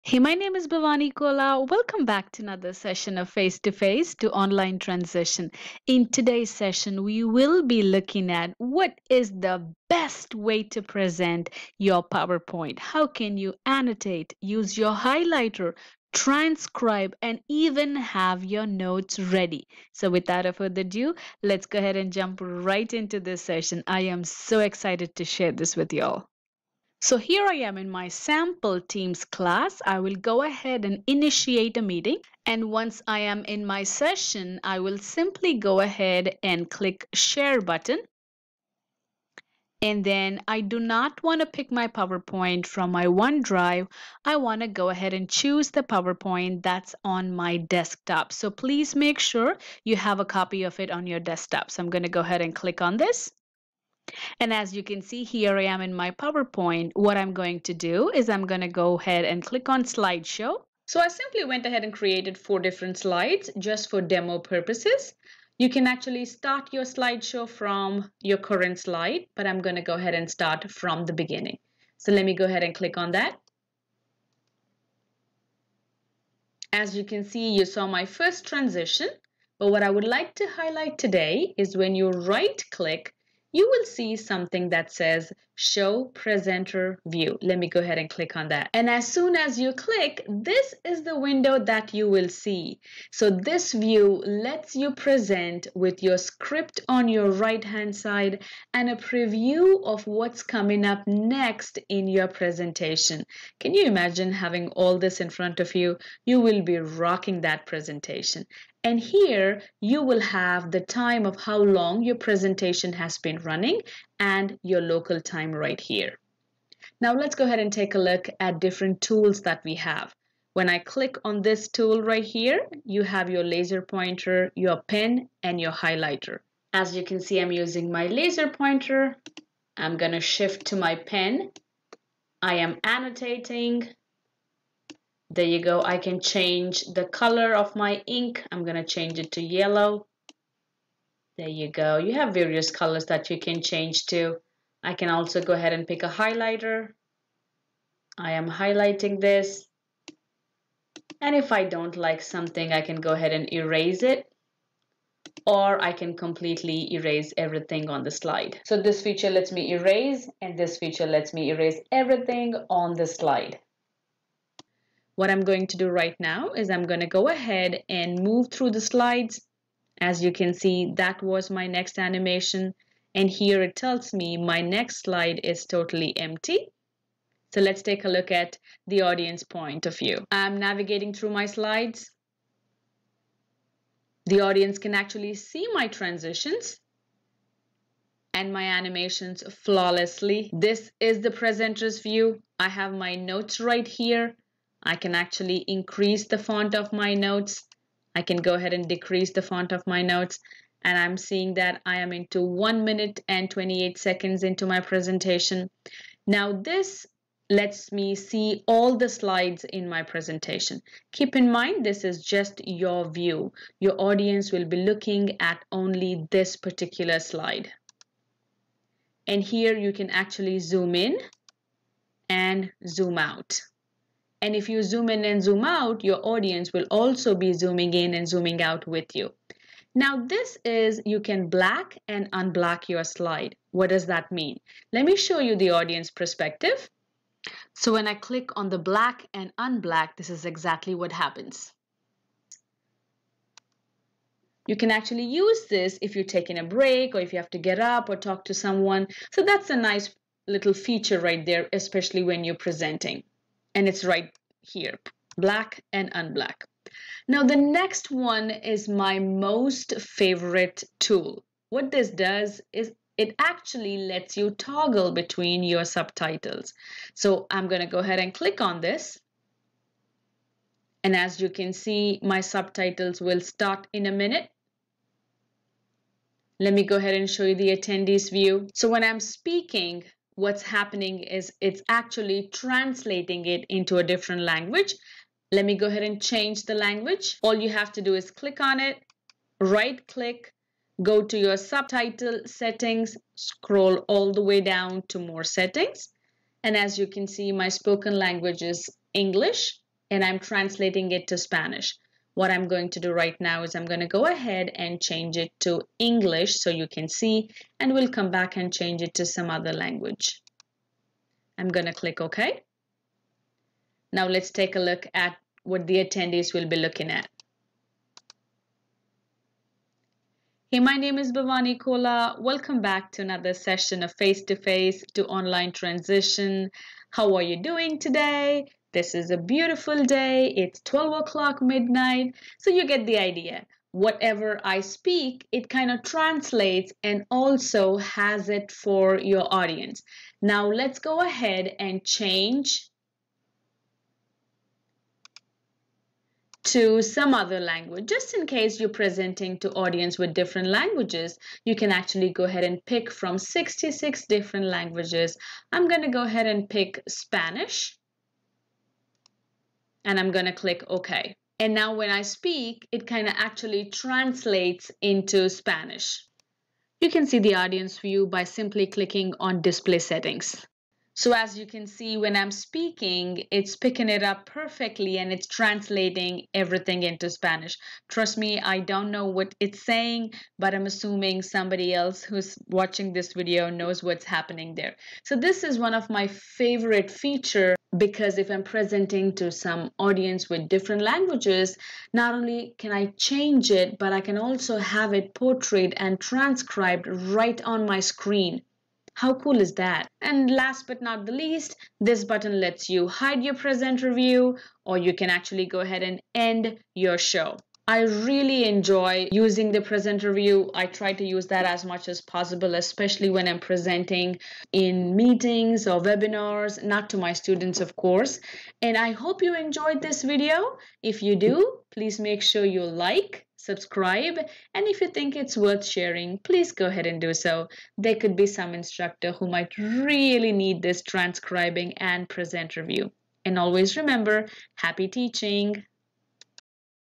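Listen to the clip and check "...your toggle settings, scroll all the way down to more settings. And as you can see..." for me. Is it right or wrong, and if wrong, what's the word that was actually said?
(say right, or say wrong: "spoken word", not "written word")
wrong: "subtitle", not "toggle".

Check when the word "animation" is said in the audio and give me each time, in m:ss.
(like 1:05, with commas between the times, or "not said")
2:51, 3:08.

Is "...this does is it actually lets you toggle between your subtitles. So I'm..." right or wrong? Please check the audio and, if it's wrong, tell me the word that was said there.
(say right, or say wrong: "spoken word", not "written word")
right.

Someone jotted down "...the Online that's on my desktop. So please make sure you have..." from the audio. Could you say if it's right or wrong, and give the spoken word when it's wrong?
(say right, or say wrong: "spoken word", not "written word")
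wrong: "PowerPoint", not "Online".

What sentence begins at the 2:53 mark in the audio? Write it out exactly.
And here it tells me my next slide is totally empty.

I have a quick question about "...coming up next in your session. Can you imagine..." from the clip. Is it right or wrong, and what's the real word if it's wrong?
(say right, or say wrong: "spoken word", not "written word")
wrong: "presentation", not "session".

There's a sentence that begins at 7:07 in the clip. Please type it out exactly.
There could be some instructor who might really need this transcribing and presenter view.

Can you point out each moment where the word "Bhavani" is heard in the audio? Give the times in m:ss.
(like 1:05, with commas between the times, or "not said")
0:00, 5:21.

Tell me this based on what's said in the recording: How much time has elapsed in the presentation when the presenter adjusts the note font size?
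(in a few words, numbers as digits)
1 minute 28 seconds.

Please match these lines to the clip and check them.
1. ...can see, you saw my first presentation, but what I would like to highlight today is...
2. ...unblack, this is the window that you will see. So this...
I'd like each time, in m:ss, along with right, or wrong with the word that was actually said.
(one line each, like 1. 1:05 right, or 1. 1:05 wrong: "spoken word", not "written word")
1. 1:17 wrong: "transition", not "presentation"
2. 1:29 wrong: "click", not "unblack".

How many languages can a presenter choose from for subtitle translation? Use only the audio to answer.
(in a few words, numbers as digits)
66.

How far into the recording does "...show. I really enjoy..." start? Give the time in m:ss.
6:47.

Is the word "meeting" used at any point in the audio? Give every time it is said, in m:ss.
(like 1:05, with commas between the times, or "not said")
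0:31, 6:55.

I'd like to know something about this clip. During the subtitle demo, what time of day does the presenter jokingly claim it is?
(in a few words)
12 o'clock midnight.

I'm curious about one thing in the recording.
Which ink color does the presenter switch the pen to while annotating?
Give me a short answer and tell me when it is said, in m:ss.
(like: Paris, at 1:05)
Yellow, at 2:19.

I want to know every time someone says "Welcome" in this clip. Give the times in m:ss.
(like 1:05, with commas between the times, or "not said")
0:01, 5:22.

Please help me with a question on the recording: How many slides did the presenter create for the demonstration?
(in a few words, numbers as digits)
4.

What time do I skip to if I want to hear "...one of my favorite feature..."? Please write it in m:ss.
6:25.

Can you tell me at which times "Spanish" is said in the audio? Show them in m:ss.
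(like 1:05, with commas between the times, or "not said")
5:01, 5:57, 6:05, 6:17.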